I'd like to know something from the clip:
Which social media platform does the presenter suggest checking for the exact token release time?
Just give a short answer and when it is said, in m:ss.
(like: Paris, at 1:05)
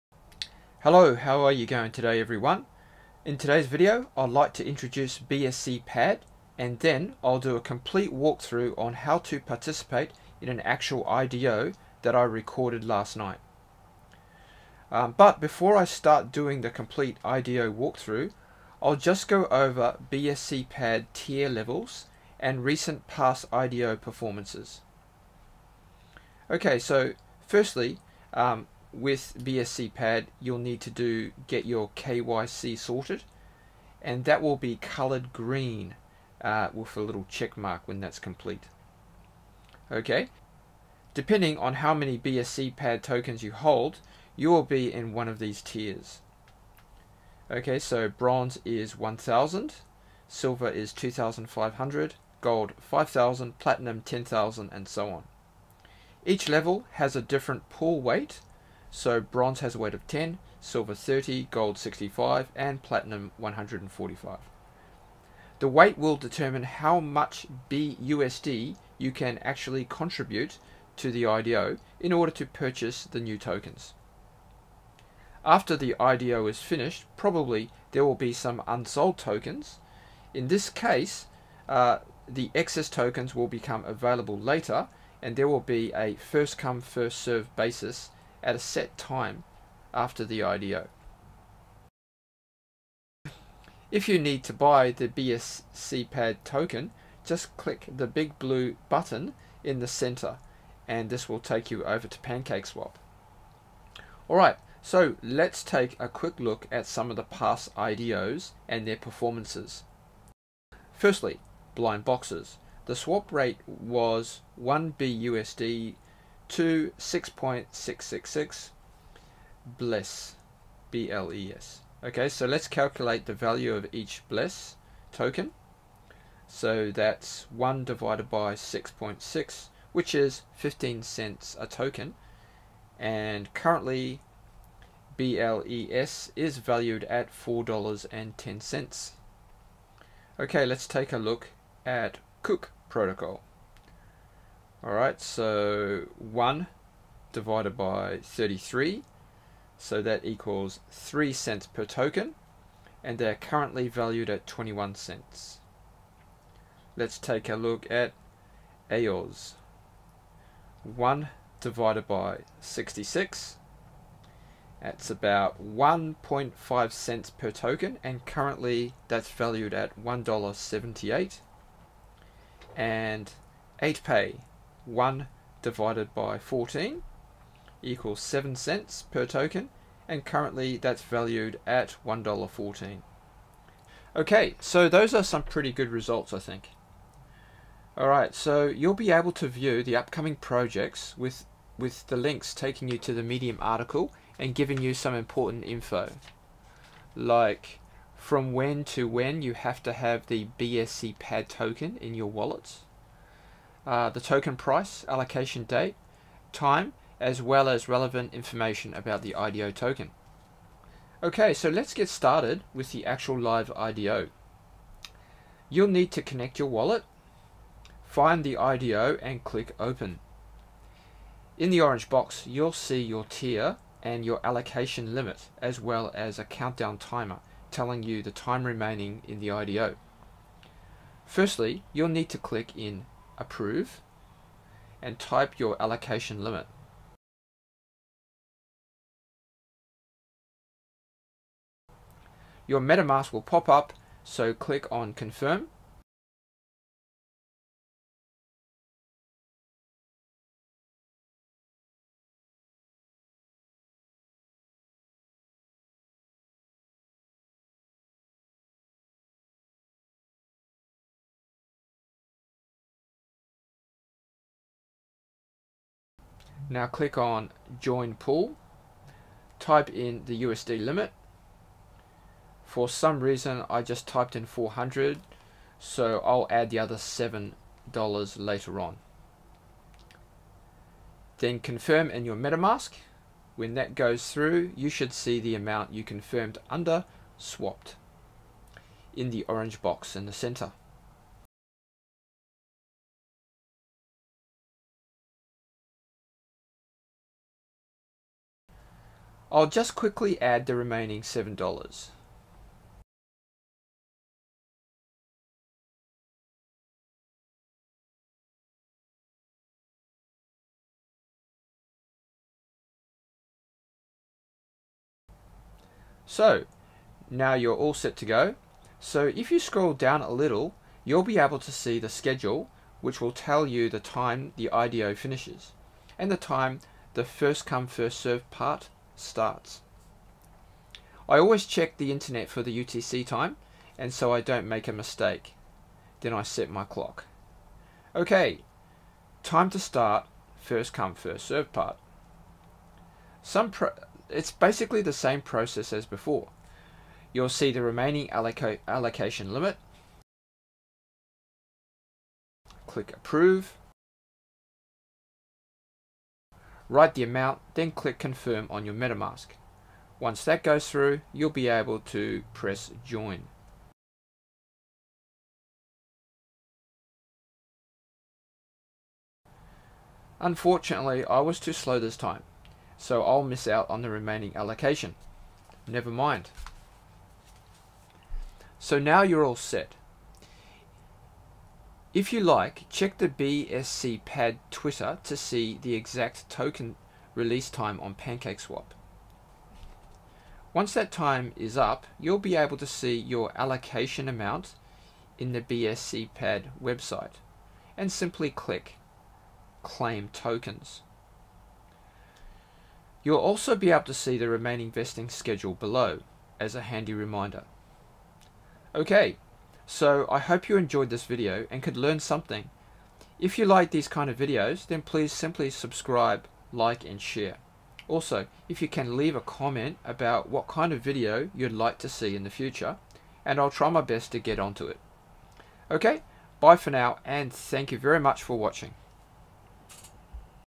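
Twitter, at 6:24.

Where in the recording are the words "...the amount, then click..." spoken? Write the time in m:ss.
5:57.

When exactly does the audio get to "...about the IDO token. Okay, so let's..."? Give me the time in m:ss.
3:28.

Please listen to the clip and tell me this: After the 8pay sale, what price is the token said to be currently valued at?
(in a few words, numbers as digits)
$1.14.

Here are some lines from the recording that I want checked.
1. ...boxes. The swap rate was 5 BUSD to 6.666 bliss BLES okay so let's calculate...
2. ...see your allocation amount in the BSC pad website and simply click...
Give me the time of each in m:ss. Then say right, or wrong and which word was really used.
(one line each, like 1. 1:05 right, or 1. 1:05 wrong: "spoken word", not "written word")
1. 1:52 wrong: "1", not "5"
2. 6:32 right.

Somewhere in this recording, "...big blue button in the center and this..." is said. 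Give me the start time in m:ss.
1:38.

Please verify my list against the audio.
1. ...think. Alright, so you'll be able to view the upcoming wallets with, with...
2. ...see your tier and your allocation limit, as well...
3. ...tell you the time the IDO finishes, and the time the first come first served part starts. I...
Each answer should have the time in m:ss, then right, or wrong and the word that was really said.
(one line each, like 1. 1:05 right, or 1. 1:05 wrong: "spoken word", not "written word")
1. 3:06 wrong: "projects", not "wallets"
2. 3:42 right
3. 5:23 right.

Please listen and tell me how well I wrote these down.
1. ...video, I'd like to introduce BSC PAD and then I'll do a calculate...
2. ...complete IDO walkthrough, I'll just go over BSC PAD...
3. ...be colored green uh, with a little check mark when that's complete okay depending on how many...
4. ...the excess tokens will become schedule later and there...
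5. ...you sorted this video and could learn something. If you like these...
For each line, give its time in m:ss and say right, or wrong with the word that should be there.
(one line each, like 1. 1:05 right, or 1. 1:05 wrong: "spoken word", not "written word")
1. 0:03 wrong: "complete", not "calculate"
2. 0:16 right
3. 0:34 right
4. 1:22 wrong: "available", not "schedule"
5. 6:50 wrong: "enjoyed", not "sorted".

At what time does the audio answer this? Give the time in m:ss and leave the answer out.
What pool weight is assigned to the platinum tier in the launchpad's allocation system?
1:02.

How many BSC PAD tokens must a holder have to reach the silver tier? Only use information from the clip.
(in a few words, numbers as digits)
2500.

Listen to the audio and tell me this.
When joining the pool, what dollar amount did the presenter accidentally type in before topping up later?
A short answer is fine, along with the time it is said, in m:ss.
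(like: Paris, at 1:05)
400, at 4:34.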